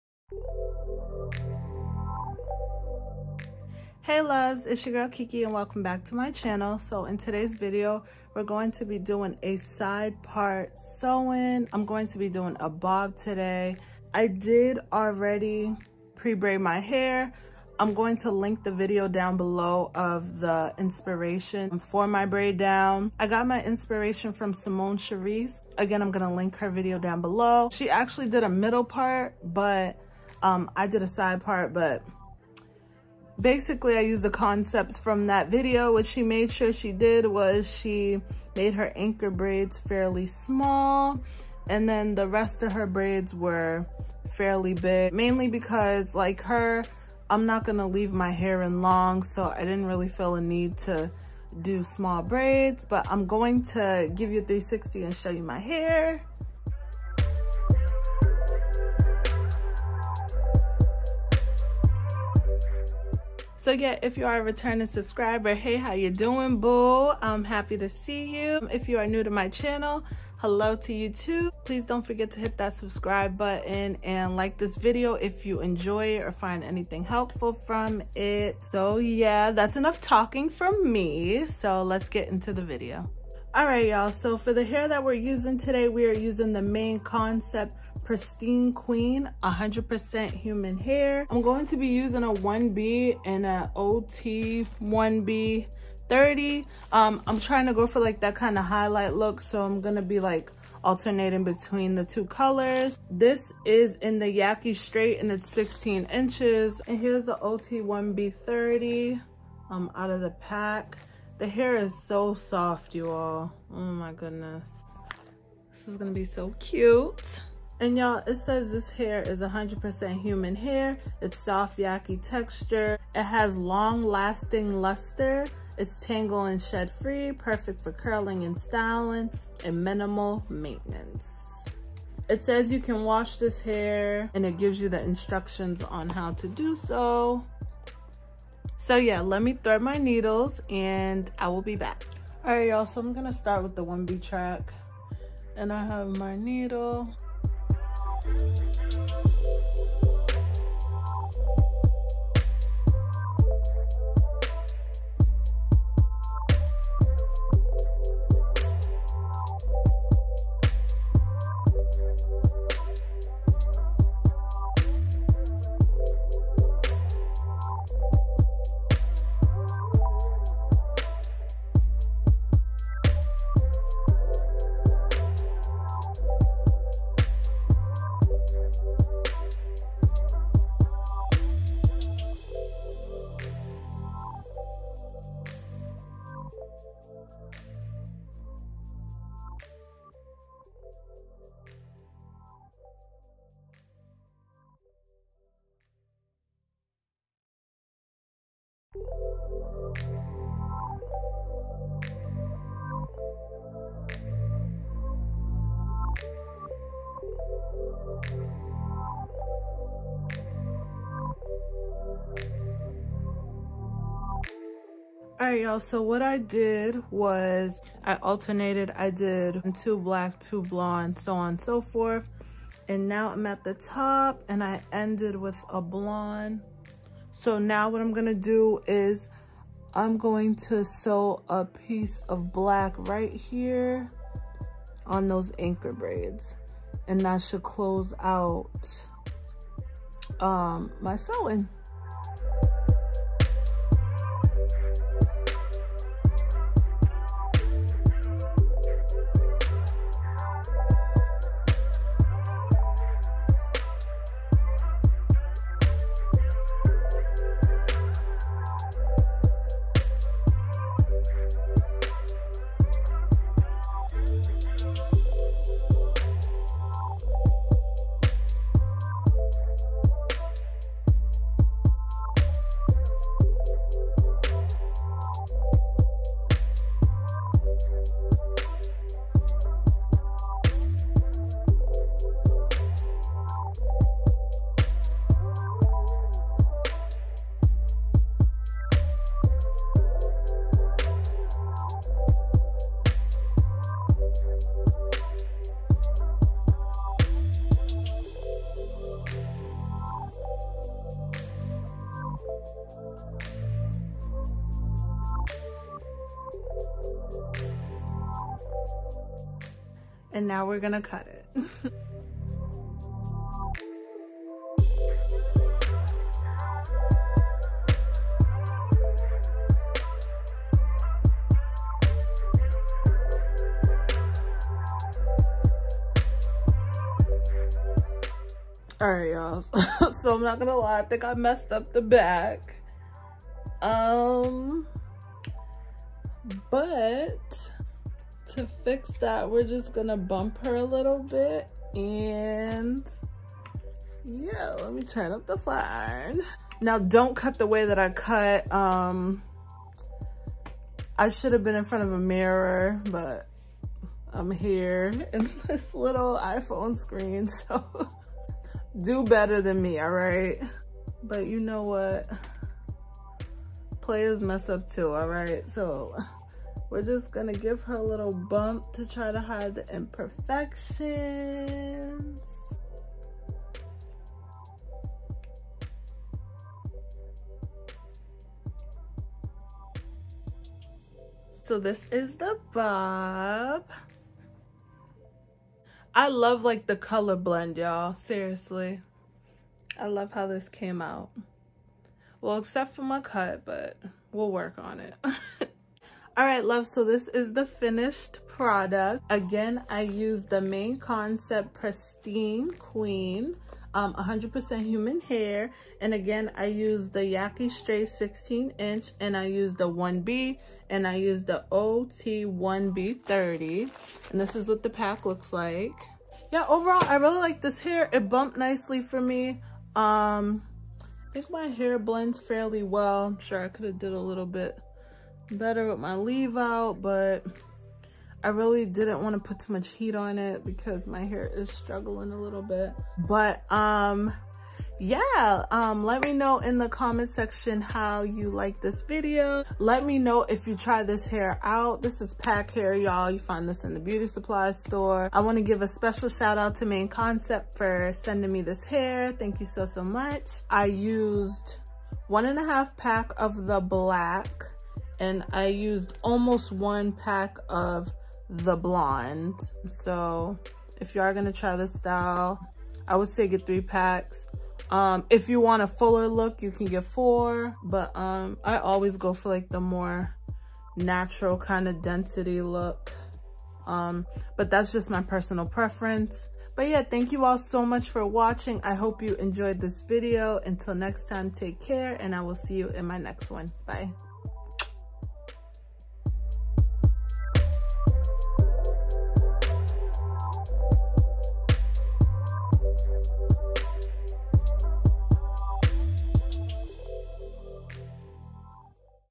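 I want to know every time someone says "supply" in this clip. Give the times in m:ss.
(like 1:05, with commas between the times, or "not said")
7:24.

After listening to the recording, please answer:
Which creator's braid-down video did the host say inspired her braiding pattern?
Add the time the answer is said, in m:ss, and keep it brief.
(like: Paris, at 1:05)
Simone Charisse, at 0:24.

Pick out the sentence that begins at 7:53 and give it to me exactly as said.
Um, but that's just my personal preference.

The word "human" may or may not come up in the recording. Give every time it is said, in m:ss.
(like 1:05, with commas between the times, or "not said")
1:30, 2:00, 6:44.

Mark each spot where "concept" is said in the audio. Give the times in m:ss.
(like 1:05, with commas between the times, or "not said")
0:34, 1:27, 6:40, 7:27.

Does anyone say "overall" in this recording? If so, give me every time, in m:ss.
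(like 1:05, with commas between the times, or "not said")
6:56.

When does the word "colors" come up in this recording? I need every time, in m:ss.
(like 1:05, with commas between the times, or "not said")
1:42, 6:26.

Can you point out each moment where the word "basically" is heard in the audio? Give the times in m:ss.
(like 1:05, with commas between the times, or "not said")
0:33.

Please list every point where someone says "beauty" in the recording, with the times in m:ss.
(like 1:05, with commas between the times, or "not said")
7:23.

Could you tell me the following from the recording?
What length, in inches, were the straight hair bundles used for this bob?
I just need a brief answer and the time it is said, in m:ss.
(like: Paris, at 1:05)
16, at 1:45.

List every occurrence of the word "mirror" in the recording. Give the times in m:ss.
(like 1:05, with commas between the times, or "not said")
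5:52.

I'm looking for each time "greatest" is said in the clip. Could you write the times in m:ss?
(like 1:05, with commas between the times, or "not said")
not said.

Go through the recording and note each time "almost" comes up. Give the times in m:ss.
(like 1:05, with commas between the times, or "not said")
7:36.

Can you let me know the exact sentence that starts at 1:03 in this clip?
So yeah, if you are a returning subscriber, hey, how you doing, boo?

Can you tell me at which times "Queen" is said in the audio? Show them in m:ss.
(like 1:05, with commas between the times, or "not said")
1:28, 6:42.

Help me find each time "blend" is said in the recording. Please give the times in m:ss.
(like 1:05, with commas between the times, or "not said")
6:27, 7:01.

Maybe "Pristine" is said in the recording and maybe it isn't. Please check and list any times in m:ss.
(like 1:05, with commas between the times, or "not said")
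1:28, 6:41.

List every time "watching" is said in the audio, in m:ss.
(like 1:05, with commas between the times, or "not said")
7:58.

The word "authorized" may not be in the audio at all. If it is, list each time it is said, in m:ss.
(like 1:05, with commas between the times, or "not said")
not said.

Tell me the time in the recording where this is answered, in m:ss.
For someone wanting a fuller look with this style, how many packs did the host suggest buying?
7:47.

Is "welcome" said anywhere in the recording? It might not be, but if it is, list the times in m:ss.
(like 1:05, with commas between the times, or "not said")
0:05.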